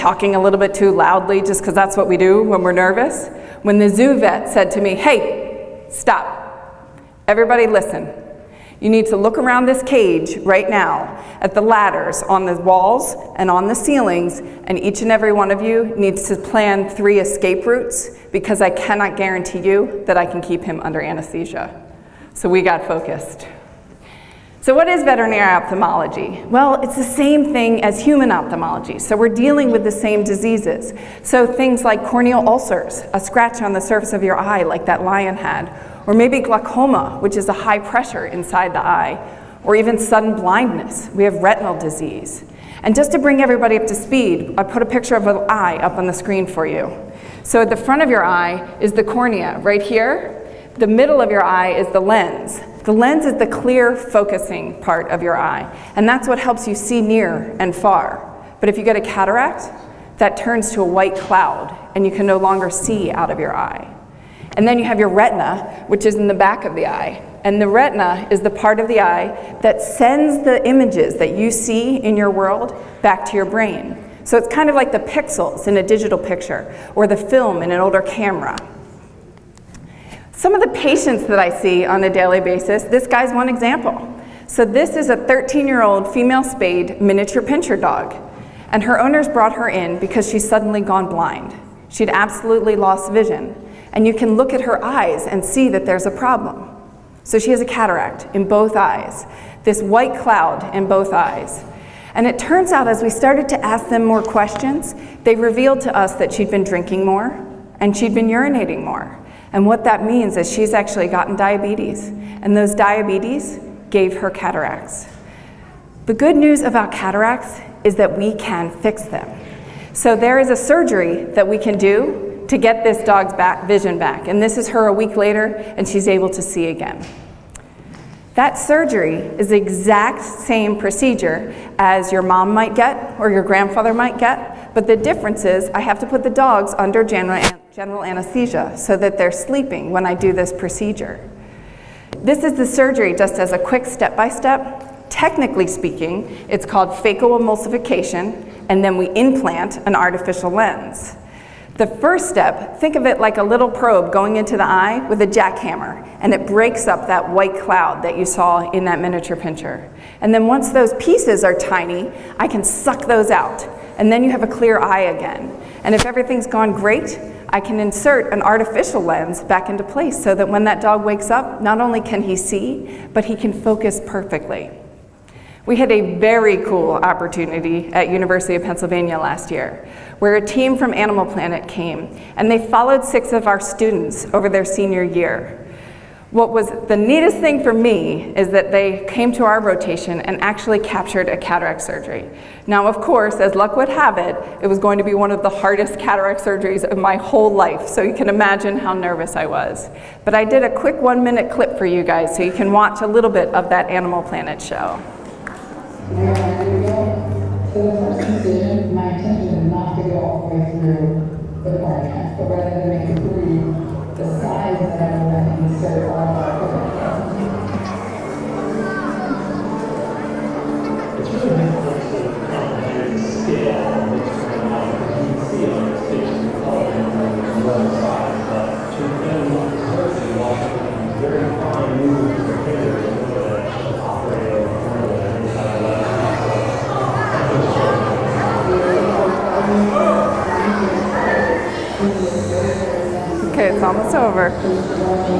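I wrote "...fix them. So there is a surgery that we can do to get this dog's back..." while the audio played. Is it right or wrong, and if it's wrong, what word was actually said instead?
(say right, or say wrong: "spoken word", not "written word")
right.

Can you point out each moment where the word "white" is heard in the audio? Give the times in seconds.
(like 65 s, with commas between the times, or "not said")
60 s, 99 s, 157 s.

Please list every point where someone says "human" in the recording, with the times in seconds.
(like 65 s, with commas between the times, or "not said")
27 s.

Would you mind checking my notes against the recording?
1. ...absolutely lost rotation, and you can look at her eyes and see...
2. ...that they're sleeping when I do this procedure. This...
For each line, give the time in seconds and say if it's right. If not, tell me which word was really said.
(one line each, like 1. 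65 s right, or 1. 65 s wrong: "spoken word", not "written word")
1. 92 s wrong: "vision", not "rotation"
2. 138 s right.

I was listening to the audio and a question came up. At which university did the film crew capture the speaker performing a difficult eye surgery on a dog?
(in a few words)
University of Pennsylvania.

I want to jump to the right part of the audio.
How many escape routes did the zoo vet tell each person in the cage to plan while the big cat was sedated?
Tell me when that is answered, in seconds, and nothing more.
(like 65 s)
16 s.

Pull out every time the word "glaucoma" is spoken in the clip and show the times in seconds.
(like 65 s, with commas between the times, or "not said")
36 s.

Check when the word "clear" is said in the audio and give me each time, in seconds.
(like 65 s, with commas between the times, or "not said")
53 s, 164 s.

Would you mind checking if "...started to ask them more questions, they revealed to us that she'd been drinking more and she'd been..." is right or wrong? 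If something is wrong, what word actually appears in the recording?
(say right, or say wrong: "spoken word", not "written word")
right.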